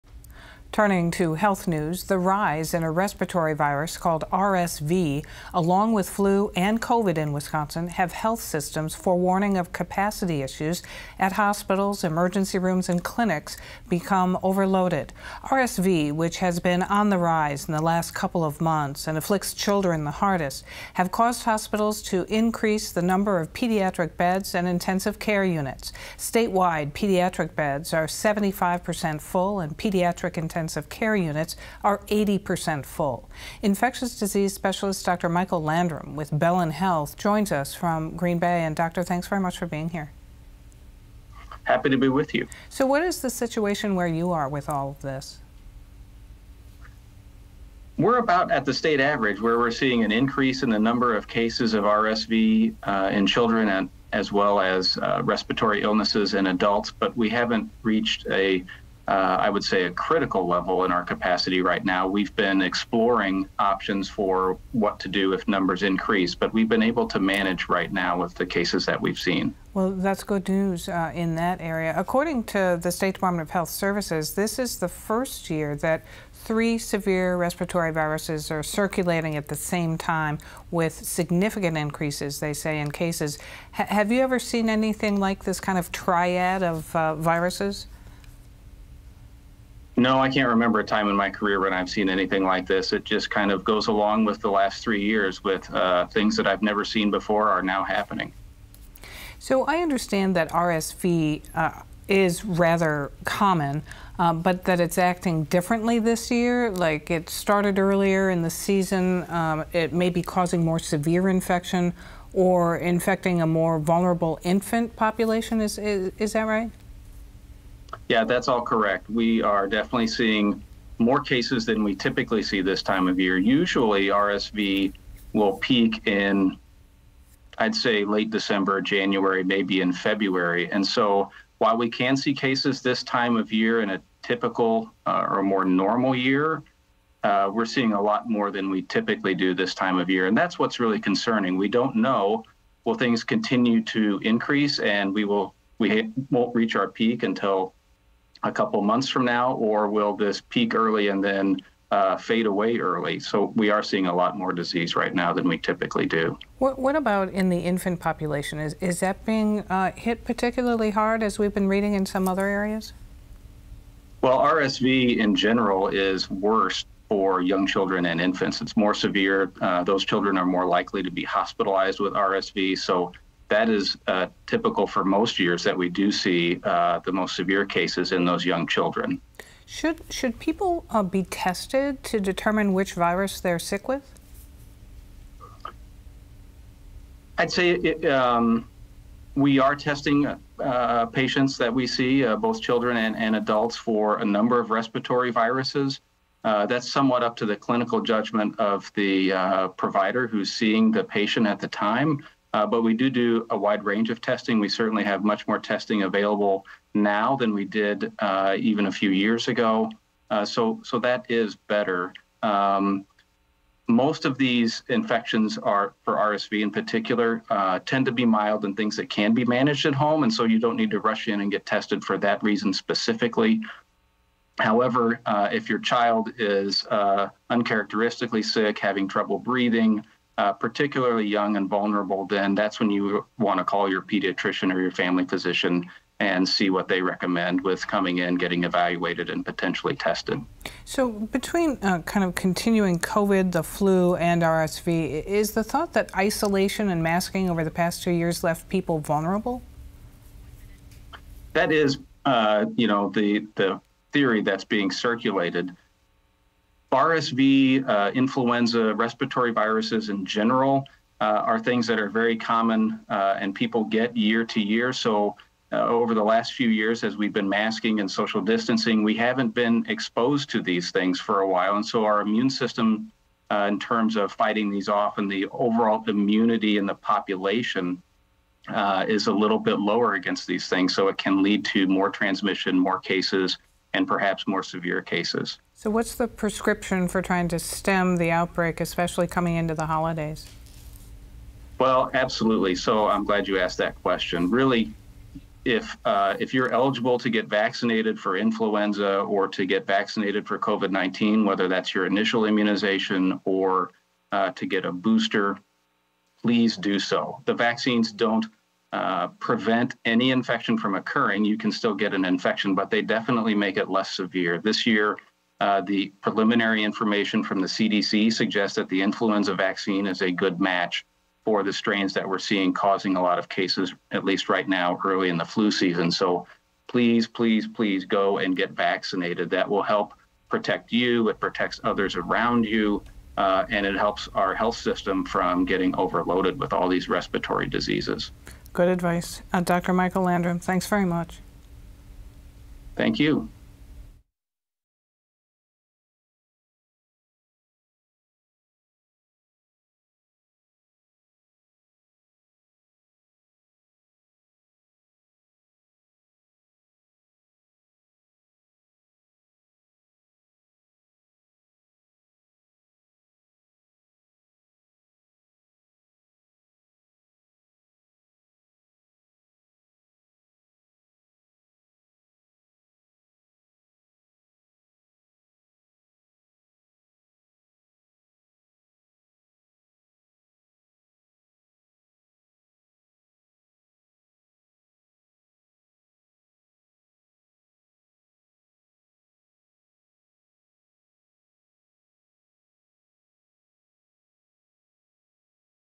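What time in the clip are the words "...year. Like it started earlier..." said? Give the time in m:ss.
1:46.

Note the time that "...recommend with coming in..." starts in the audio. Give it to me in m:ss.
3:57.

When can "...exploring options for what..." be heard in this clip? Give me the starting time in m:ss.
1:02.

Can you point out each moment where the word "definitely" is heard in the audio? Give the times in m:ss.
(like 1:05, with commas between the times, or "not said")
1:59, 5:13.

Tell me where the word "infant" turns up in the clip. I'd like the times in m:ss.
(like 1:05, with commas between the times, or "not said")
1:54, 2:37, 2:48.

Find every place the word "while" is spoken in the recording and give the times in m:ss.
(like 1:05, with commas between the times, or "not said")
2:11, 4:31.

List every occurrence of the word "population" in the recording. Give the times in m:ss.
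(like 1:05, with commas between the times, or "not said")
1:54, 2:37, 4:36.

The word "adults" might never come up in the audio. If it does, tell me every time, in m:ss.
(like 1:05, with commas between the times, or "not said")
0:56, 3:13.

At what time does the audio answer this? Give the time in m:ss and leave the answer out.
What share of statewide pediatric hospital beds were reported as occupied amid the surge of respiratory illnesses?
0:28.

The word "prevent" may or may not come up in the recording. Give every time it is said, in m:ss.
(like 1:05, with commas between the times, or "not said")
5:09.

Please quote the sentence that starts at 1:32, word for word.
It just kind of goes along with the last three years with uh, things that I've never seen before are now happening.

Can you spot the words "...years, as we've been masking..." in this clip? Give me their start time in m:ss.
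4:26.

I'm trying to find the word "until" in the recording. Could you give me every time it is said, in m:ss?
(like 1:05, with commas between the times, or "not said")
2:27.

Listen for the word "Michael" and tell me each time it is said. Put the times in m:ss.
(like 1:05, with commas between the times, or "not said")
0:35, 5:39.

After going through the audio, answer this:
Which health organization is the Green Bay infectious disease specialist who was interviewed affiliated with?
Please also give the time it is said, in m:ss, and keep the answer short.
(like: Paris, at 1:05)
Bellin Health, at 0:36.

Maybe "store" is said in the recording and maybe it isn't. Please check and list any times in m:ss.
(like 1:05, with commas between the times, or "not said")
not said.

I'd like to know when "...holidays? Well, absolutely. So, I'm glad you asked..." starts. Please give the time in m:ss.
4:49.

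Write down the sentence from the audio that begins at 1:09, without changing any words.
Well, that's good news uh, in that area.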